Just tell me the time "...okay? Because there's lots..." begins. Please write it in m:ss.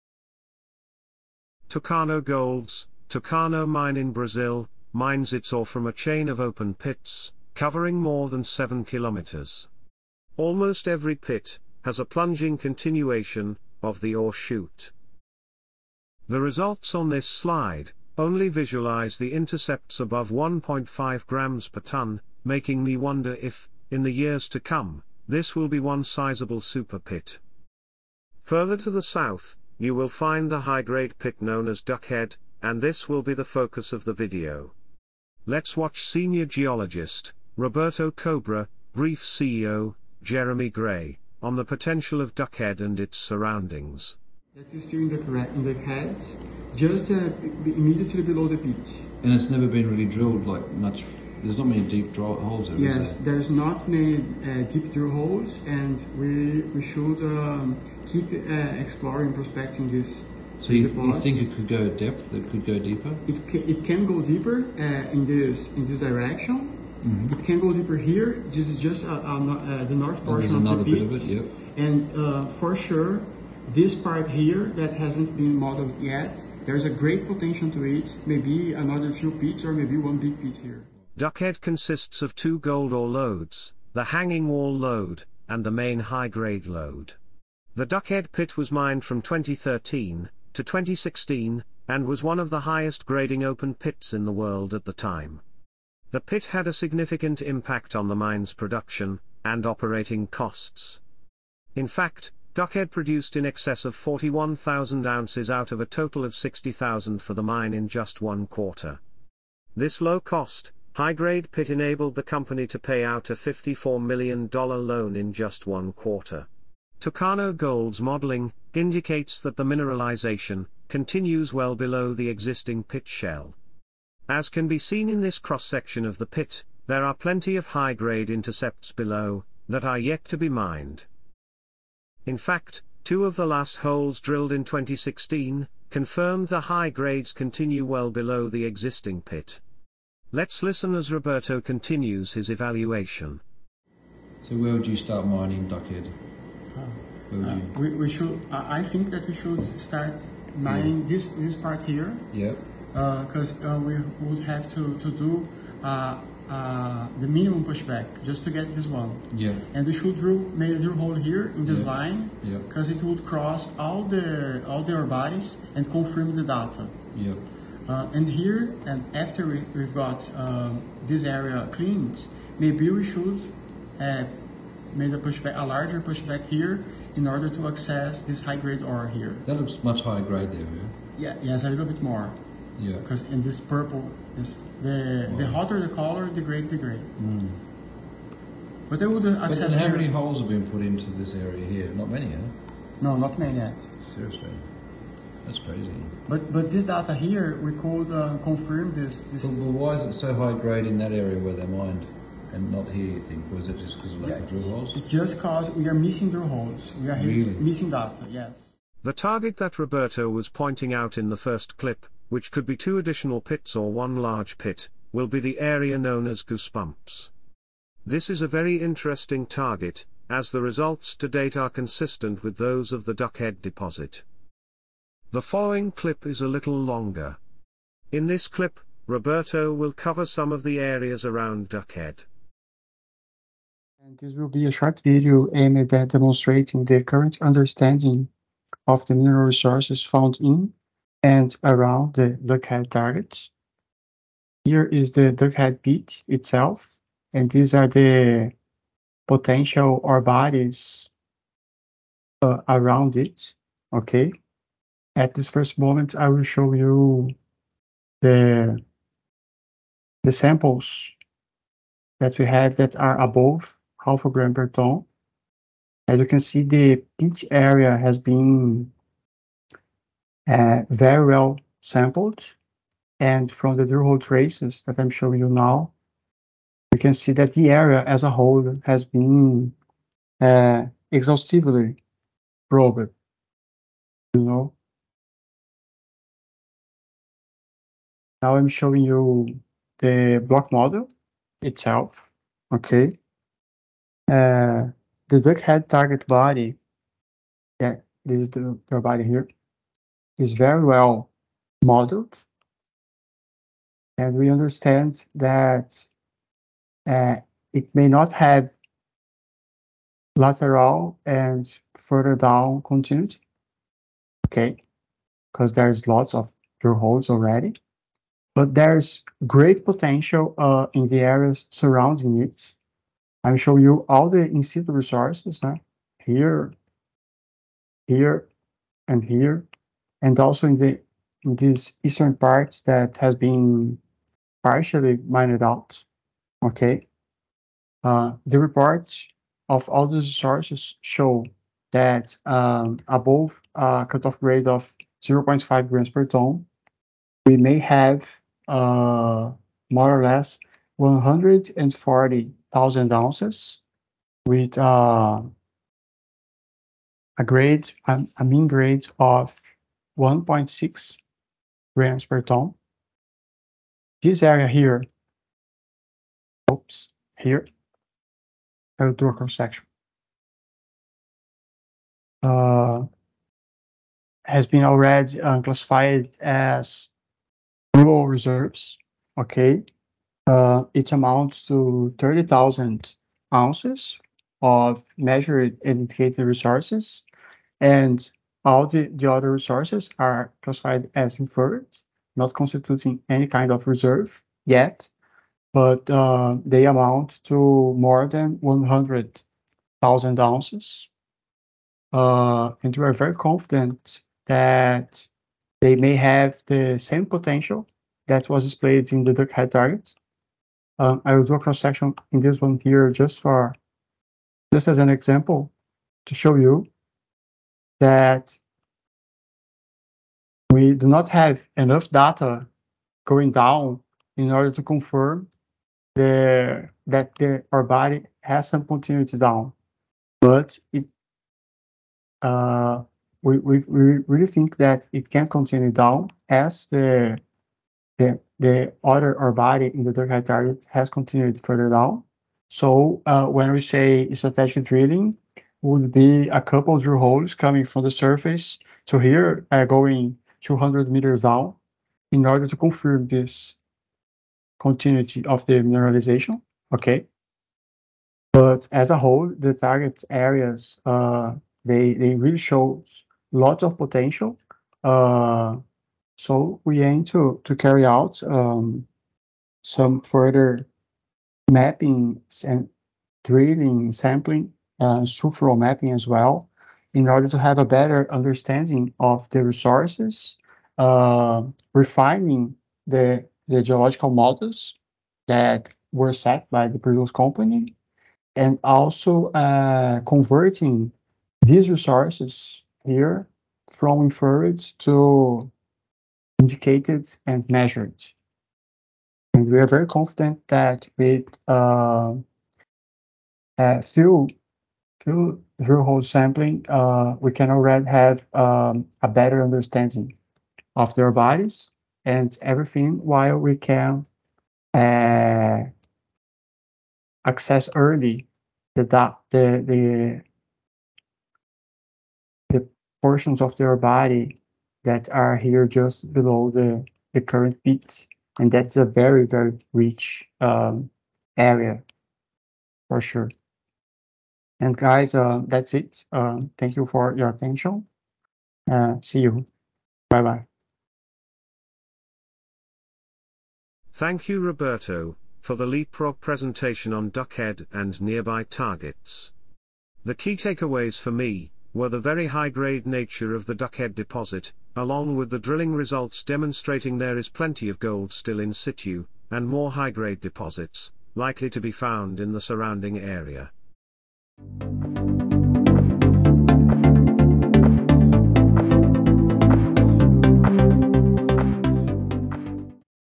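5:14.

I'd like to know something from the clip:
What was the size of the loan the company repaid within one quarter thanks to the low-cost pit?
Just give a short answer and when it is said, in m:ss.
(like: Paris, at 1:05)
$54 million, at 1:53.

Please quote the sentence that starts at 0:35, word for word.
Let's watch senior geologist, Roberto Cobra, brief CEO, Jeremy Gray, on the potential of Duckhead and its surroundings.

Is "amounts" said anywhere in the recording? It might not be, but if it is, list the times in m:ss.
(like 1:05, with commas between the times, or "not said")
6:21, 6:36.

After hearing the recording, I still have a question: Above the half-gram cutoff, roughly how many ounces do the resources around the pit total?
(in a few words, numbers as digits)
140,000 ounces.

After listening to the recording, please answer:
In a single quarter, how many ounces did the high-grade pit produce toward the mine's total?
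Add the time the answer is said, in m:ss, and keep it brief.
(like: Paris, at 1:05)
41,000, at 1:43.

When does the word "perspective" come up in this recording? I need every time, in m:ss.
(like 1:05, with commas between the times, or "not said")
not said.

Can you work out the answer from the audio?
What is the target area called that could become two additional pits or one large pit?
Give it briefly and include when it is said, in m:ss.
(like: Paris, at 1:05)
goosebumps, at 3:36.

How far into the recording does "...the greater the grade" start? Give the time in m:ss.
3:06.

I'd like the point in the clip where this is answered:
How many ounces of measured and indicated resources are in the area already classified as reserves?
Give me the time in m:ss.
6:22.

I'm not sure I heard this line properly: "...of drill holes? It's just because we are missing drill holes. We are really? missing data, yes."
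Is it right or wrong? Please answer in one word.
right.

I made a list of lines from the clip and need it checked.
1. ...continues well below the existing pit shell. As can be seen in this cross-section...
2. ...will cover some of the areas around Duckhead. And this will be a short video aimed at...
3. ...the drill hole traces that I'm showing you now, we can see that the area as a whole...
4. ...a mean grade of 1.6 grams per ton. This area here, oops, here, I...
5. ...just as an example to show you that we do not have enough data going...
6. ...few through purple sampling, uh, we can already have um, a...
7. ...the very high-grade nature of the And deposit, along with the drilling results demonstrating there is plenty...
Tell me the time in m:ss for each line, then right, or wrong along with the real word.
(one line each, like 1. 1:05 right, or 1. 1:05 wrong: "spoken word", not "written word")
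1. 2:00 right
2. 3:49 right
3. 4:33 right
4. 5:58 right
5. 6:54 right
6. 8:25 wrong: "whole", not "purple"
7. 9:12 wrong: "Duckhead", not "And".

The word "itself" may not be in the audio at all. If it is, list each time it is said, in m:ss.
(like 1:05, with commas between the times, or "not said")
4:06, 4:51.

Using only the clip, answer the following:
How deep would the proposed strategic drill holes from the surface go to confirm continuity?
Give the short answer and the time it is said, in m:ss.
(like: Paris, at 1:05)
200 meters, at 7:30.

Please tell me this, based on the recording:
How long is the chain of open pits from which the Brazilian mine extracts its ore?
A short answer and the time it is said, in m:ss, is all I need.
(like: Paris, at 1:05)
more than 7 kilometers, at 0:07.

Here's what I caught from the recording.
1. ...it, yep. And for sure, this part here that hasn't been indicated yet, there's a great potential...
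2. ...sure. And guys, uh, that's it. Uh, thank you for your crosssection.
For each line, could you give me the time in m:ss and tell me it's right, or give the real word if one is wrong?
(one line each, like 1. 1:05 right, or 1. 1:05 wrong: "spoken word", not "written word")
1. 1:11 wrong: "modeled", not "indicated"
2. 8:53 wrong: "attention", not "crosssection".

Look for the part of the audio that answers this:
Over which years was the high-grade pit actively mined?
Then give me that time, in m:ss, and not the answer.
1:29.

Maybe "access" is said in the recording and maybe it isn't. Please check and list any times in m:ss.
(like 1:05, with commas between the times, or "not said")
2:57, 3:09, 8:37.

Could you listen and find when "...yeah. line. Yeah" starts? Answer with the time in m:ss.
2:41.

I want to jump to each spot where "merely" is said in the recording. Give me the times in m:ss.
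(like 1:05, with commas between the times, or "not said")
not said.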